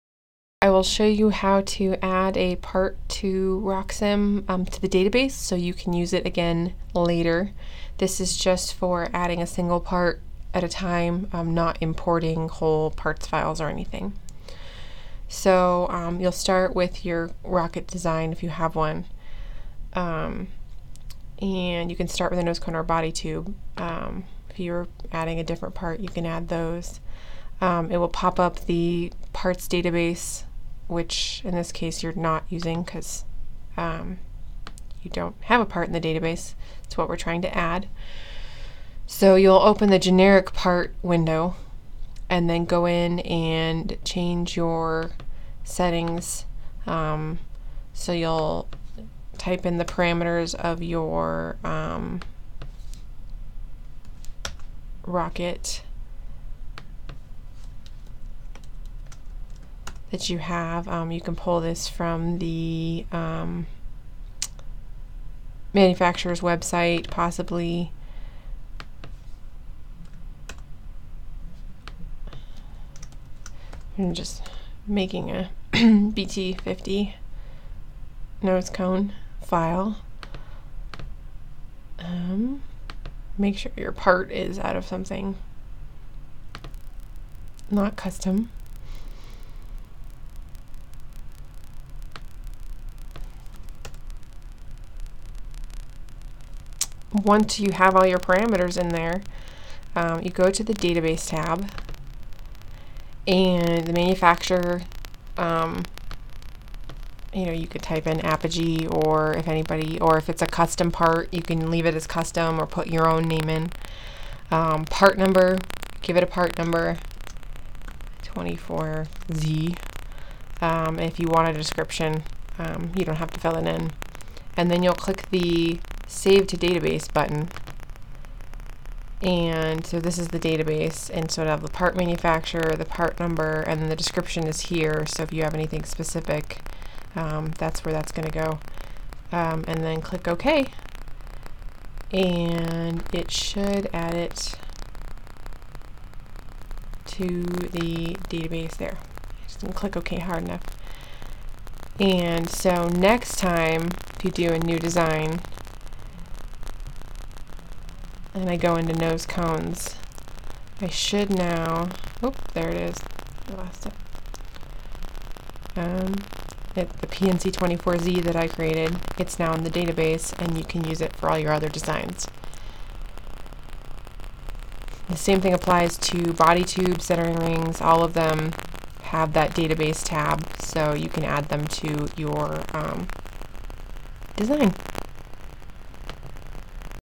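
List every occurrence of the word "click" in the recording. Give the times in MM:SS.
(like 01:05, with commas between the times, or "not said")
02:04, 02:20, 02:29.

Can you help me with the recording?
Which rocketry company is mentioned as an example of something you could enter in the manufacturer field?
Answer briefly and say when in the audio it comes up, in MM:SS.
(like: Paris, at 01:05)
Apogee, at 01:48.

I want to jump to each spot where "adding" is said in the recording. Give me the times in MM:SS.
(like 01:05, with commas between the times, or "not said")
00:09, 00:25.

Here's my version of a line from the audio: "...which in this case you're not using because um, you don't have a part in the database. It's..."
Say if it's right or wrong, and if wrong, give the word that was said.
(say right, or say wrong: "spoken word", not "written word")
right.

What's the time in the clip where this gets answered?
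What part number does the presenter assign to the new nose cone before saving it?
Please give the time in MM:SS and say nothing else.
01:58.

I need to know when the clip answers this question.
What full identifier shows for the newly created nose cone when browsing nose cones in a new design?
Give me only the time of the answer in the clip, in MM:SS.
02:47.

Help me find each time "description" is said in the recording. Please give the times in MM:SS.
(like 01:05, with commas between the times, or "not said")
02:01, 02:13.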